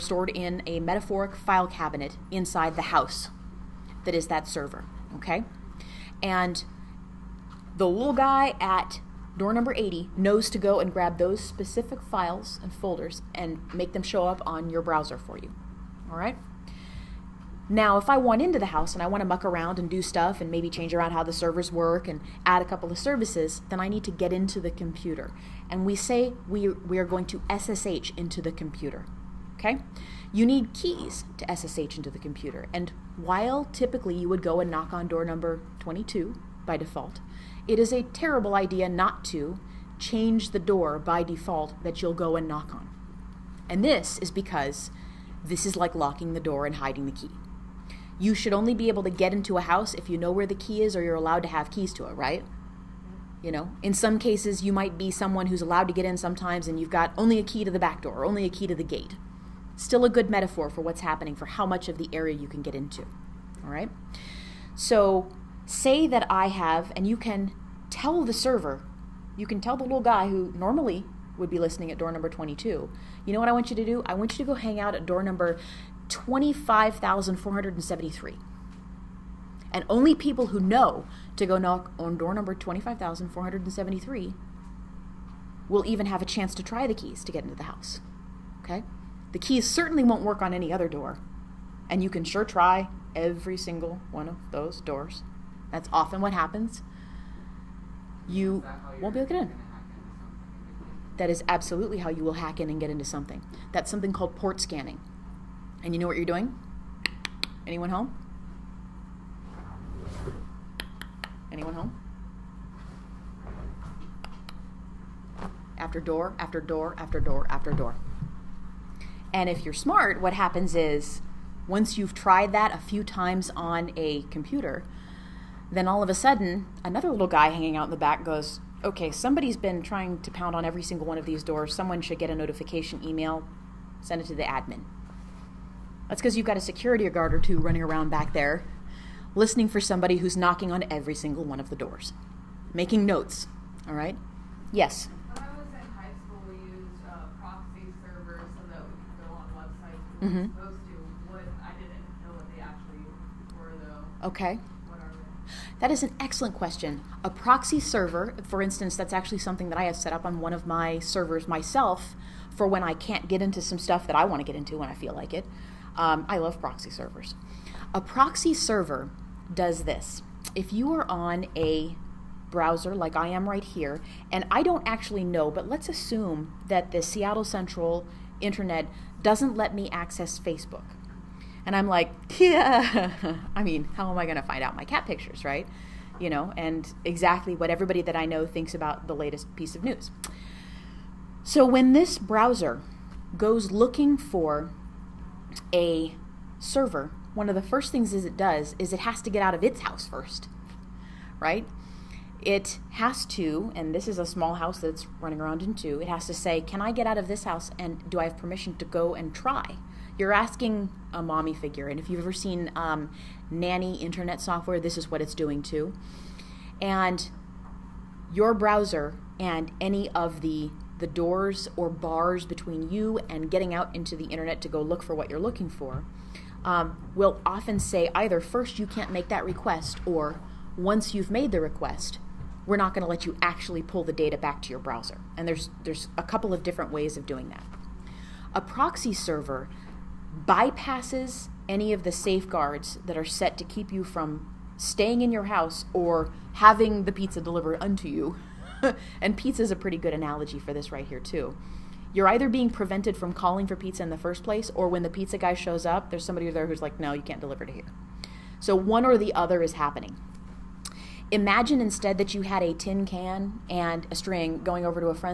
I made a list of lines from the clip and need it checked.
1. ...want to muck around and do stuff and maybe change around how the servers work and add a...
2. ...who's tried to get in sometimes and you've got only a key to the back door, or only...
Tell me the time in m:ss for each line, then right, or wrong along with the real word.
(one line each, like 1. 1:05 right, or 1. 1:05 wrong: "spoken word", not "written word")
1. 0:19 right
2. 0:55 wrong: "allowed", not "tried".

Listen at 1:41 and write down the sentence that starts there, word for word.
That is absolutely how you will hack in and get into something.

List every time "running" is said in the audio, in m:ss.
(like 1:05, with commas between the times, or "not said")
2:17, 3:25.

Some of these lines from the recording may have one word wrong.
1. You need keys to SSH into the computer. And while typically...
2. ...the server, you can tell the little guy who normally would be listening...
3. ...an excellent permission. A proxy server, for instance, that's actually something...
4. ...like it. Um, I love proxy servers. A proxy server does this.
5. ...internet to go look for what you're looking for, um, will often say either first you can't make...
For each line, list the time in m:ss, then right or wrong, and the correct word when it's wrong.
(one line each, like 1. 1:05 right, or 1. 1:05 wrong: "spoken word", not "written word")
1. 0:30 right
2. 1:08 right
3. 2:36 wrong: "question", not "permission"
4. 2:45 right
5. 3:44 right.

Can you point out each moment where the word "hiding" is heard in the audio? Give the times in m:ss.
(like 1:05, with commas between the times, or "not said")
0:46.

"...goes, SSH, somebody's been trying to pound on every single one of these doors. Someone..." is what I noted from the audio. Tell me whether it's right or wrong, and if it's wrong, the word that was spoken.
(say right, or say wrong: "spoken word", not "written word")
wrong: "Okay", not "SSH".